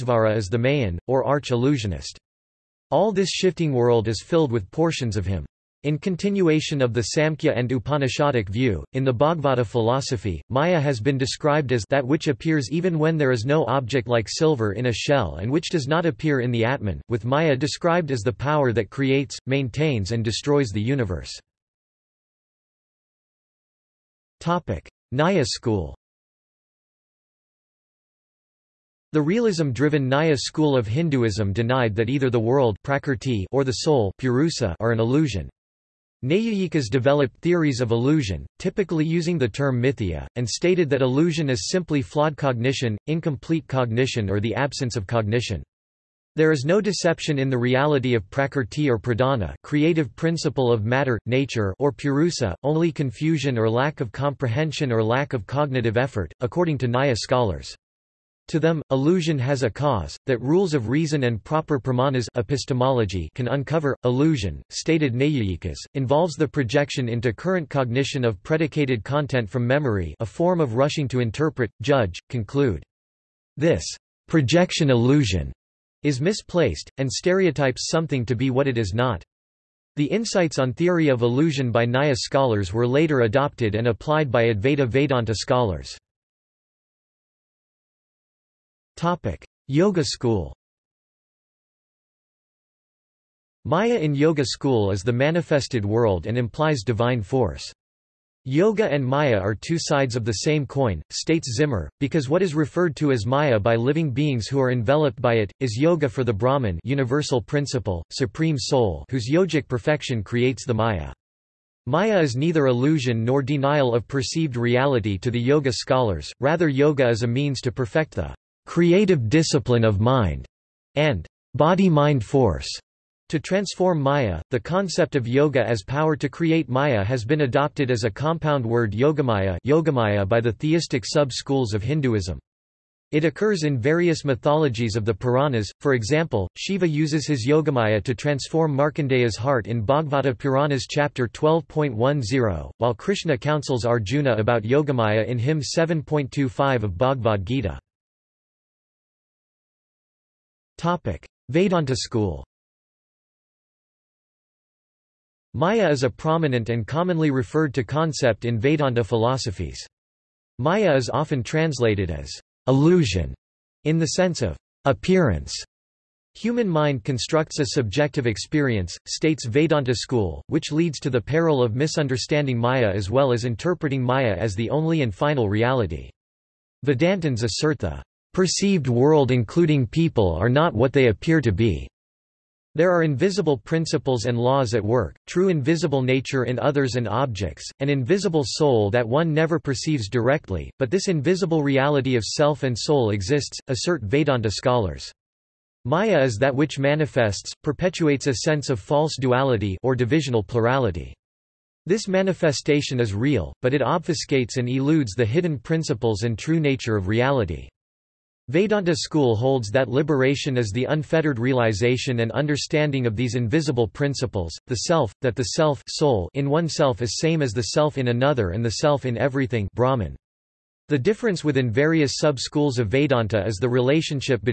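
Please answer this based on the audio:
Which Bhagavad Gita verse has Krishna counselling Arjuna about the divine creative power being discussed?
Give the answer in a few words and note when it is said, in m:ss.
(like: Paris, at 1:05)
7.25, at 2:25.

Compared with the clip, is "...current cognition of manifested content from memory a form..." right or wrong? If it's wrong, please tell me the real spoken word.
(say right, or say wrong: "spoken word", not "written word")
wrong: "predicated", not "manifested".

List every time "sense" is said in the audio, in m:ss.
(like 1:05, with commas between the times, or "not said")
2:44, 3:18.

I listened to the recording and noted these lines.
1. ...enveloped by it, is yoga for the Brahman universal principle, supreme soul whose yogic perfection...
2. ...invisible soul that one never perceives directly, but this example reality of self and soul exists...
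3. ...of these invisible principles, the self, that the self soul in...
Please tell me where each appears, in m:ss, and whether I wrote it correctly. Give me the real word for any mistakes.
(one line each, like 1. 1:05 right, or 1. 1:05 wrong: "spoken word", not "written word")
1. 1:44 right
2. 3:07 wrong: "invisible", not "example"
3. 3:33 right.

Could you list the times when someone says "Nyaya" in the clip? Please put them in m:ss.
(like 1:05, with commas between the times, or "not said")
0:25, 0:30, 0:56, 1:21.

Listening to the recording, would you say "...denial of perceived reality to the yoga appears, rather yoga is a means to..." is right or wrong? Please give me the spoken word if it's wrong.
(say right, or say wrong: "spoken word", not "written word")
wrong: "scholars", not "appears".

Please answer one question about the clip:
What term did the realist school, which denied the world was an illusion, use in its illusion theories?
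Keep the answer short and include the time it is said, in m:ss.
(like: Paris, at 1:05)
mithya, at 0:39.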